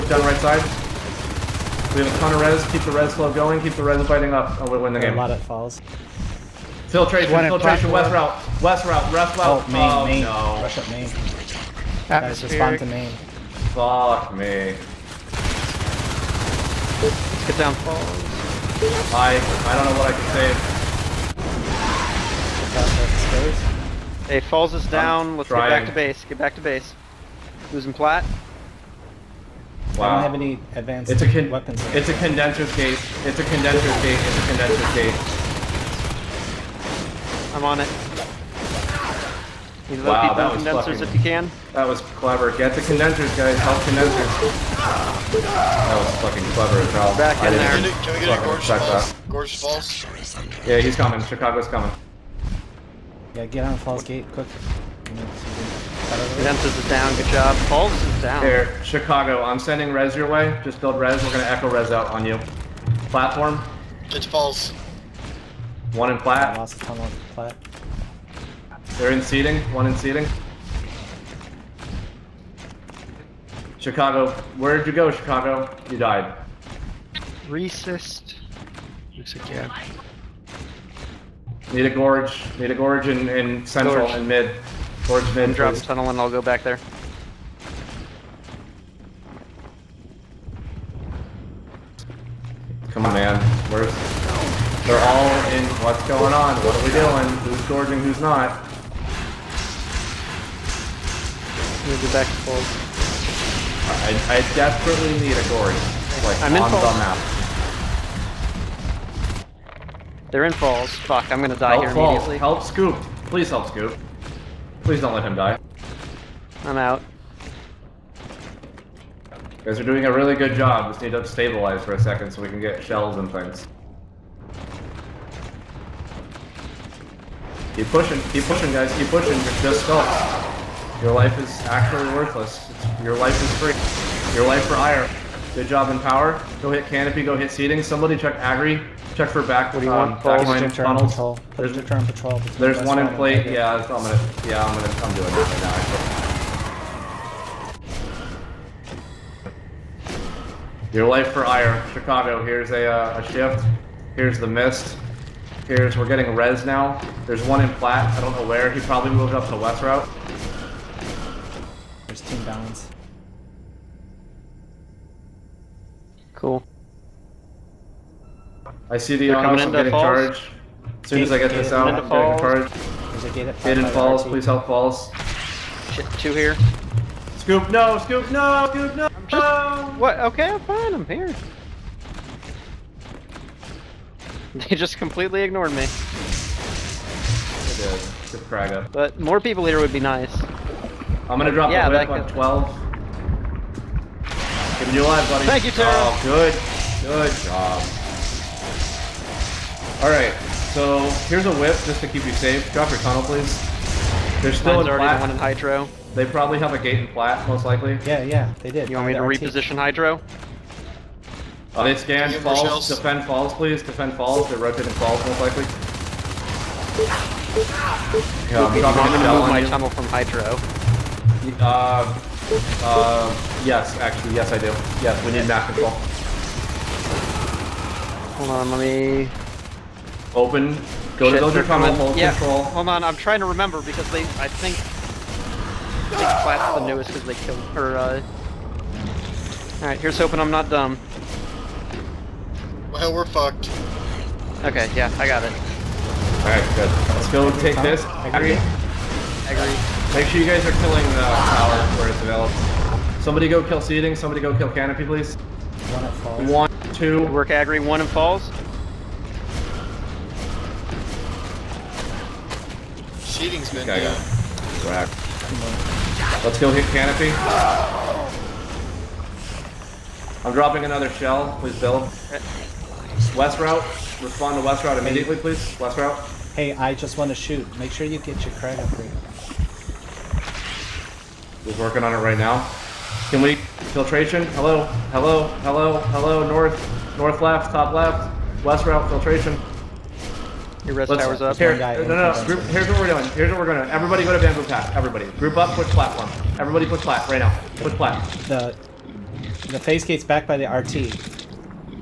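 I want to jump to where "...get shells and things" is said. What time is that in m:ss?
2:02.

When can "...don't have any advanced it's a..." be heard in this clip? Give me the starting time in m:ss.
0:30.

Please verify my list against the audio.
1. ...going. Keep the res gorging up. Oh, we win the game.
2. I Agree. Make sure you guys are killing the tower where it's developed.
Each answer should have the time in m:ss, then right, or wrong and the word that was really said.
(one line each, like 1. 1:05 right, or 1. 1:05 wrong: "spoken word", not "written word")
1. 0:03 wrong: "fighting", not "gorging"
2. 4:08 right.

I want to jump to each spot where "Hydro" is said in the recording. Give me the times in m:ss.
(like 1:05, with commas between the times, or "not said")
3:25, 3:29, 3:40.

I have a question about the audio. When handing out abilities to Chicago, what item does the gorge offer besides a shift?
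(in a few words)
the mist.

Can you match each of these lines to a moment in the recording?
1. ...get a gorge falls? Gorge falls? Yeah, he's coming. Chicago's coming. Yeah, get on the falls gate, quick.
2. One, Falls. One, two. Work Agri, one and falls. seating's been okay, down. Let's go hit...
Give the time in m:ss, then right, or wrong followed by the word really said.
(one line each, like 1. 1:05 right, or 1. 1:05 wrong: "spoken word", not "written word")
1. 0:48 right
2. 4:15 right.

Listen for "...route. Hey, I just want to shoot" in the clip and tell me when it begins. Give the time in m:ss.
4:35.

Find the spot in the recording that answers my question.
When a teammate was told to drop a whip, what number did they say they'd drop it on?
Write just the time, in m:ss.
3:12.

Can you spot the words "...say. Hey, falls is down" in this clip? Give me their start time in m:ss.
0:24.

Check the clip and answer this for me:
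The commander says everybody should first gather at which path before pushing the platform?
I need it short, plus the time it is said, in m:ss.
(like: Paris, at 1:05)
bamboo path, at 4:54.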